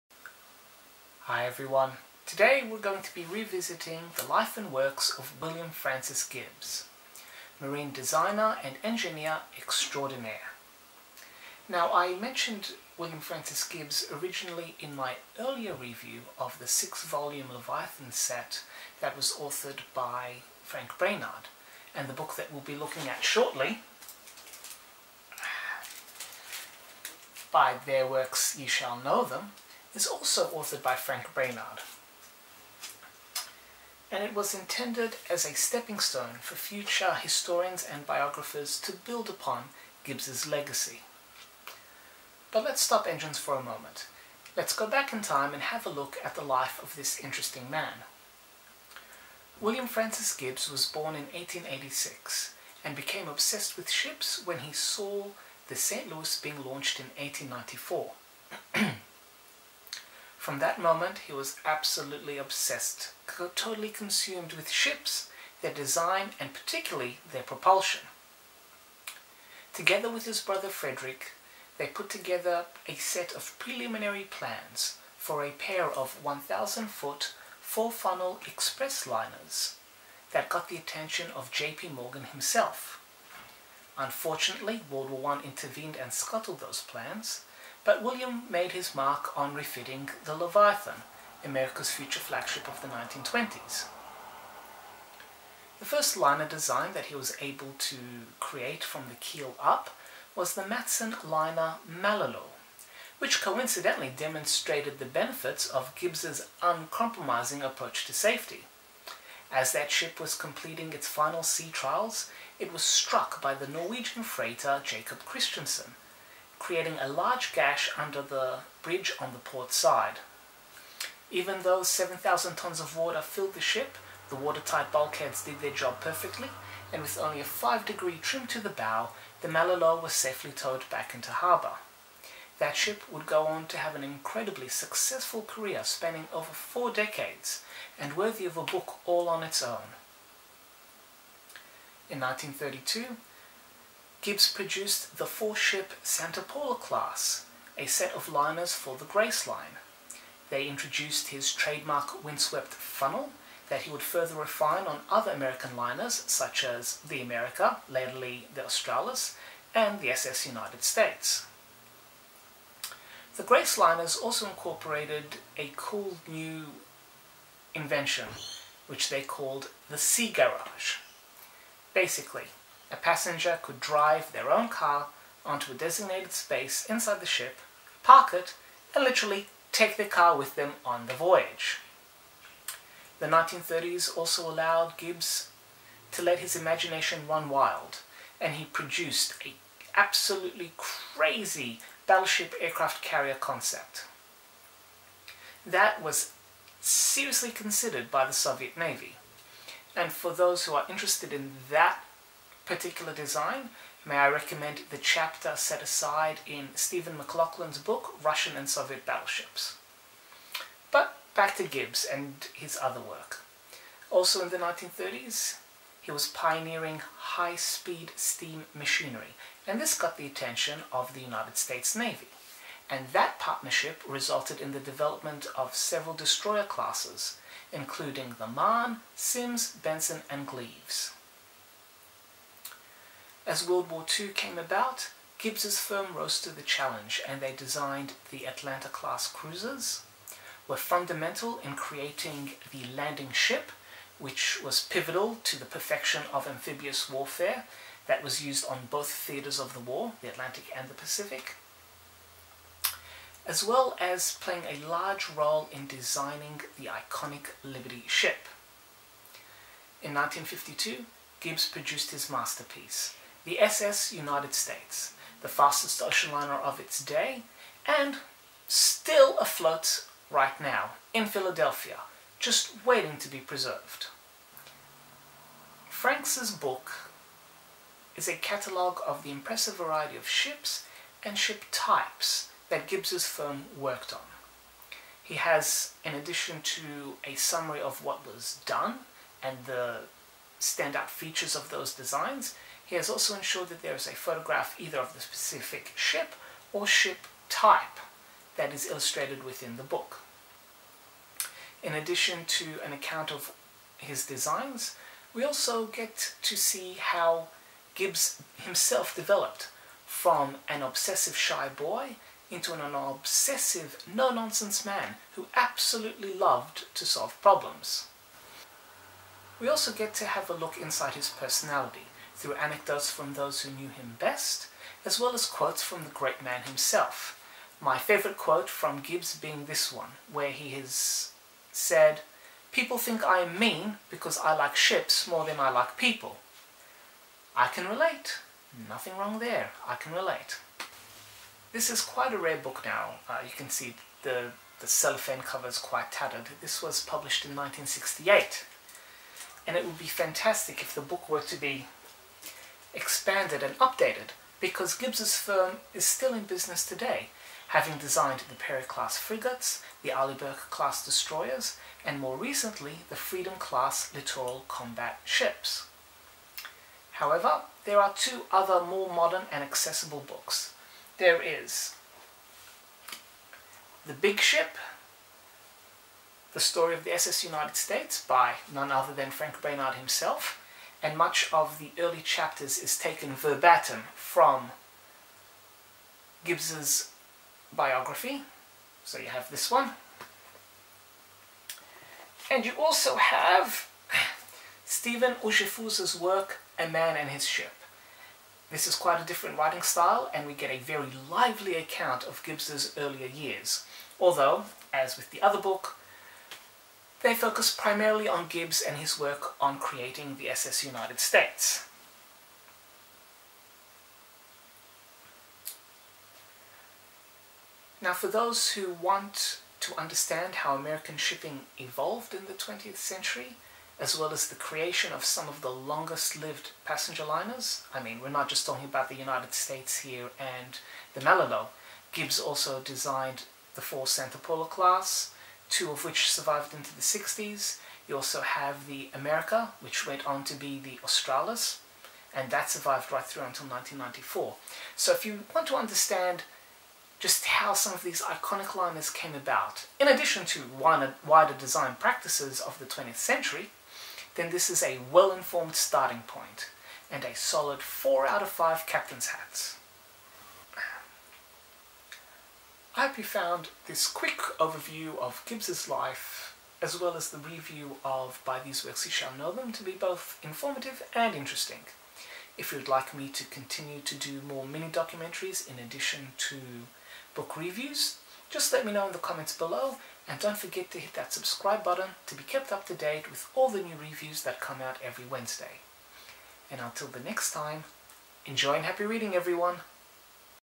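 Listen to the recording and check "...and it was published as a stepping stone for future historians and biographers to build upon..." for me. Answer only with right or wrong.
wrong.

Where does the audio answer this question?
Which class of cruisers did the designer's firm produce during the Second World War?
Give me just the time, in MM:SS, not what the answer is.
03:58.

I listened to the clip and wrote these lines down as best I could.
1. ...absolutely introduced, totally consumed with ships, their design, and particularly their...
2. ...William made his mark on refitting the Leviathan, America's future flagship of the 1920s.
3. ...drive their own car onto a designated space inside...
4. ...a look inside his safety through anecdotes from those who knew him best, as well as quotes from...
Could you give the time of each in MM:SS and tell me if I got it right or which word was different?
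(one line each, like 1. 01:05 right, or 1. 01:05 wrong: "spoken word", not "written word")
1. 01:01 wrong: "obsessed", not "introduced"
2. 01:28 right
3. 02:53 right
4. 05:20 wrong: "personality", not "safety".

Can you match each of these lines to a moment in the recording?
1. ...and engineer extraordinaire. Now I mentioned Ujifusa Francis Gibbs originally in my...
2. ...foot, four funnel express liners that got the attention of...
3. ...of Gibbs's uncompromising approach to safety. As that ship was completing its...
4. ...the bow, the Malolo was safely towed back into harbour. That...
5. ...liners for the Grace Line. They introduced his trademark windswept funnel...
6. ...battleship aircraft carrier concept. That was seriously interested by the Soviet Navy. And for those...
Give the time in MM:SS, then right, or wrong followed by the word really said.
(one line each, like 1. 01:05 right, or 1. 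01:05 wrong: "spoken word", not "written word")
1. 00:08 wrong: "William", not "Ujifusa"
2. 01:16 right
3. 01:45 right
4. 02:08 right
5. 02:28 right
6. 03:12 wrong: "considered", not "interested".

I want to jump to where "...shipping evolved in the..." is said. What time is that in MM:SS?
07:01.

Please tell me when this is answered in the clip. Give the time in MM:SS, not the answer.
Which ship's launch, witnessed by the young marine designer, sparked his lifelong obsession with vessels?
00:55.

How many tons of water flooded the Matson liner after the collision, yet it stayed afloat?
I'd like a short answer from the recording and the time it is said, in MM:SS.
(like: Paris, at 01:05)
7,000, at 02:01.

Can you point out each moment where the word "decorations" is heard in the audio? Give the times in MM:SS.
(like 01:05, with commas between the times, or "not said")
not said.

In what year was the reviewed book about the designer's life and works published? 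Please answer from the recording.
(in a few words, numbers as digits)
1968.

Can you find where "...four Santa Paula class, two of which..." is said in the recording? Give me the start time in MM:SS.
07:13.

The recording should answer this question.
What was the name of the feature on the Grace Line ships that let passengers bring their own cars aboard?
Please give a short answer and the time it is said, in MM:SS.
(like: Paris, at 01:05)
sea garage, at 02:49.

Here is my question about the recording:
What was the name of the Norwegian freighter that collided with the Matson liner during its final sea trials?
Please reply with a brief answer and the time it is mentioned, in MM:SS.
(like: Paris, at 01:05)
Jacob Christensen, at 01:54.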